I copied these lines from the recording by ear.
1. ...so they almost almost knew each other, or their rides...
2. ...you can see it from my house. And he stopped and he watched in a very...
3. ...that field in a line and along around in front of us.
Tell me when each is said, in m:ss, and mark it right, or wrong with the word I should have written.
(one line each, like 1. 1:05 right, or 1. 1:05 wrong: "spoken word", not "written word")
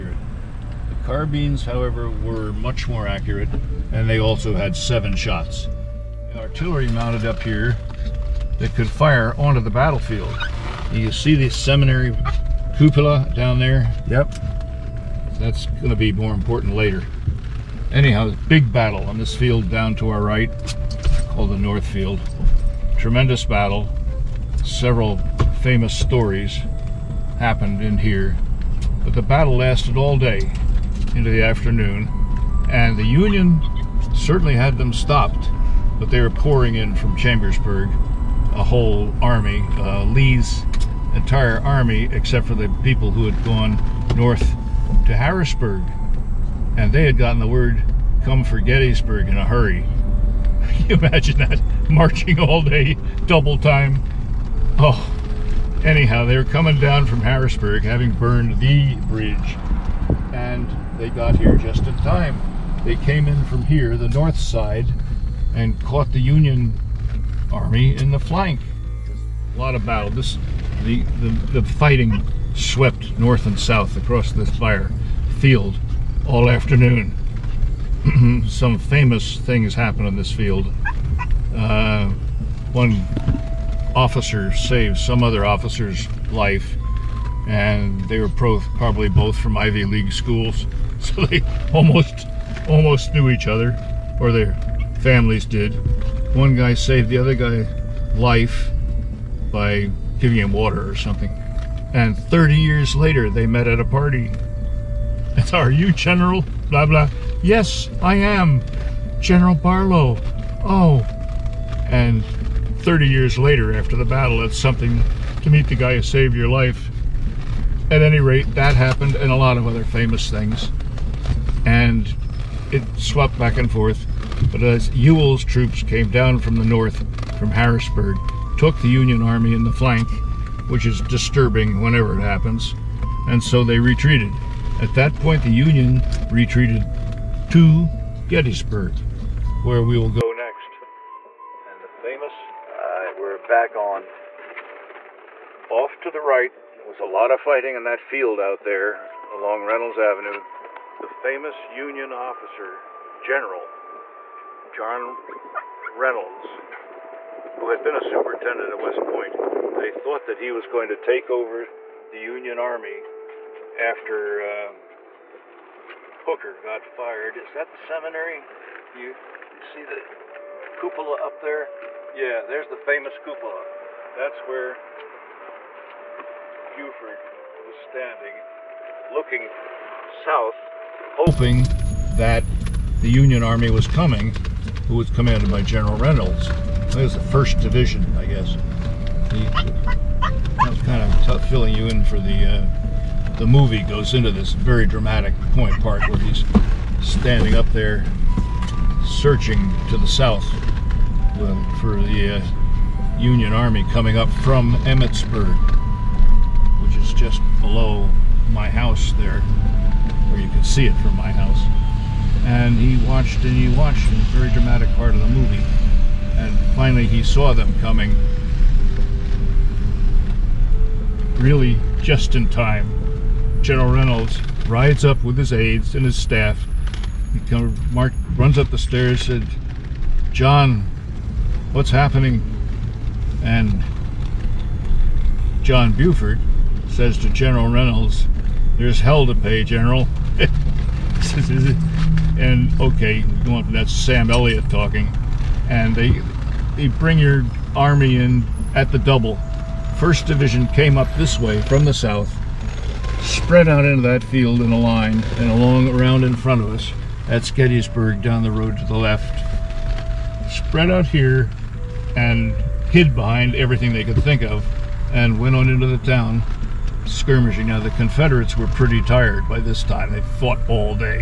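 1. 1:31 wrong: "families", not "rides"
2. 3:30 wrong: "watched", not "stopped"
3. 4:14 right.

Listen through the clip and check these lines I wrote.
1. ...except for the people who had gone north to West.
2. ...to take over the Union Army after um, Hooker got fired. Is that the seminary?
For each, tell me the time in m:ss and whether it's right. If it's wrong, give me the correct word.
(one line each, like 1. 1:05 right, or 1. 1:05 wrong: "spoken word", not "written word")
1. 0:42 wrong: "Harrisburg", not "West"
2. 2:40 right.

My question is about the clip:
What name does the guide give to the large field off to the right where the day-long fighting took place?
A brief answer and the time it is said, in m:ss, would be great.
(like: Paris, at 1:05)
North Field, at 0:21.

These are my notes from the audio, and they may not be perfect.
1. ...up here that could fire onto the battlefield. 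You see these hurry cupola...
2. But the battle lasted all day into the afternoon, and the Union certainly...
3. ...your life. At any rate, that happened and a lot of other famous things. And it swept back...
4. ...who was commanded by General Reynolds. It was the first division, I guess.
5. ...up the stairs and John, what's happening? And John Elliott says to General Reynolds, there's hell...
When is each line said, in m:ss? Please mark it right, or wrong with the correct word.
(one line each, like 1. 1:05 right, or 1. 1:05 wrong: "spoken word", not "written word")
1. 0:07 wrong: "seminary", not "hurry"
2. 0:29 right
3. 1:56 right
4. 3:04 right
5. 3:48 wrong: "Buford", not "Elliott".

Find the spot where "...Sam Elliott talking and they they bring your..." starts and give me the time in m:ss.
4:03.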